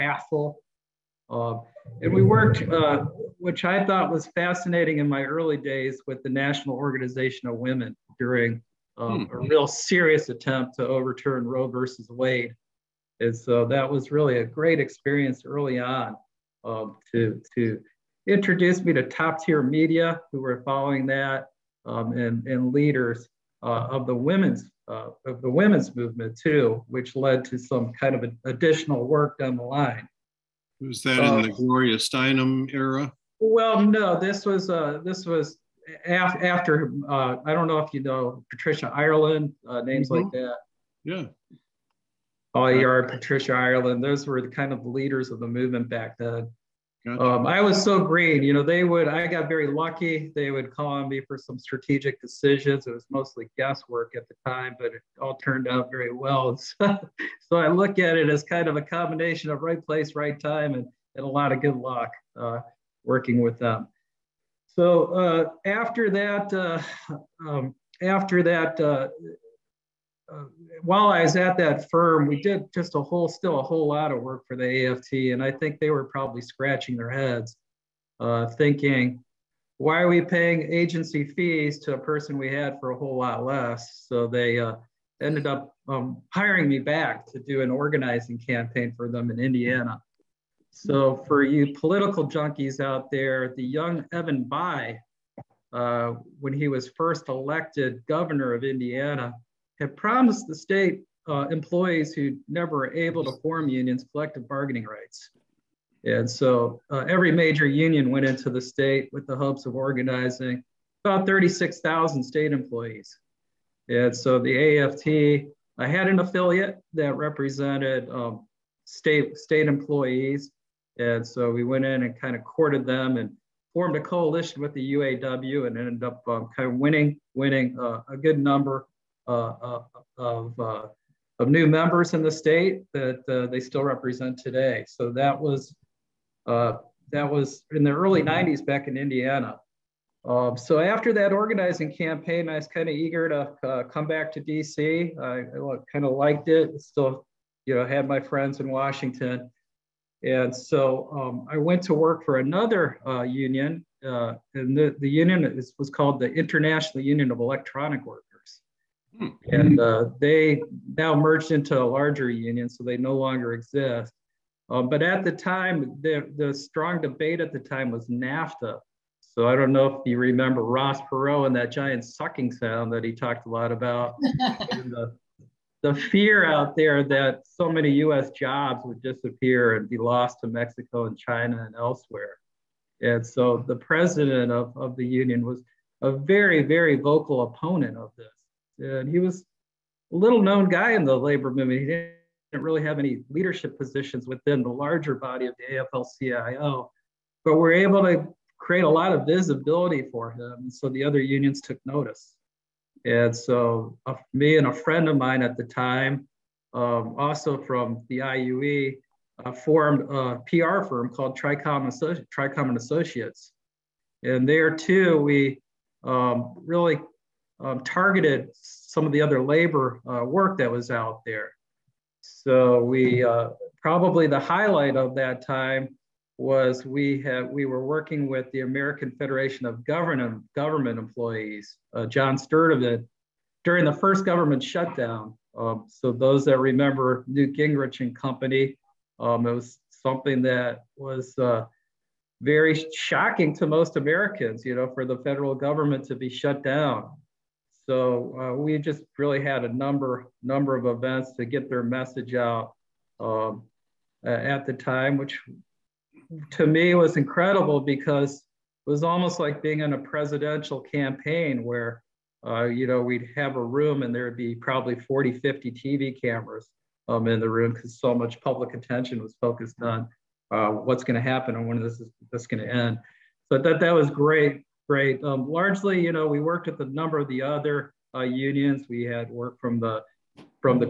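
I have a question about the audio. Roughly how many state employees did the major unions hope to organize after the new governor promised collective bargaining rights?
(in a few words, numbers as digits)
36,000.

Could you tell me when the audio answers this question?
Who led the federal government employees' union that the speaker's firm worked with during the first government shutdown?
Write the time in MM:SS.
03:52.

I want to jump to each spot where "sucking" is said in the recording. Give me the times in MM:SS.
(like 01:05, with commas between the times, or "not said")
02:52.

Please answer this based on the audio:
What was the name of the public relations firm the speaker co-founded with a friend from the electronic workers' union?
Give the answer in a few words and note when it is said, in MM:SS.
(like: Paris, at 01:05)
Tricom and Associates, at 03:32.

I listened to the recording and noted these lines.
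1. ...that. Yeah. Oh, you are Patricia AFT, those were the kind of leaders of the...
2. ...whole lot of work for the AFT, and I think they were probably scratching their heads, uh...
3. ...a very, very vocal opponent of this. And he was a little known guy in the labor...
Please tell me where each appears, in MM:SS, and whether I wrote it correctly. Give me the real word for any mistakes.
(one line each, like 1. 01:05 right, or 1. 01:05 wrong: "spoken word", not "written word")
1. 00:40 wrong: "Ireland", not "AFT"
2. 01:13 right
3. 03:06 right.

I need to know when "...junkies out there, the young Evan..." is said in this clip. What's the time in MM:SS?
01:32.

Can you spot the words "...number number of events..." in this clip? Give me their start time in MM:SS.
04:09.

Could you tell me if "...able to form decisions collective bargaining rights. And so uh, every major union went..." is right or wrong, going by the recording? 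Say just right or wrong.
wrong.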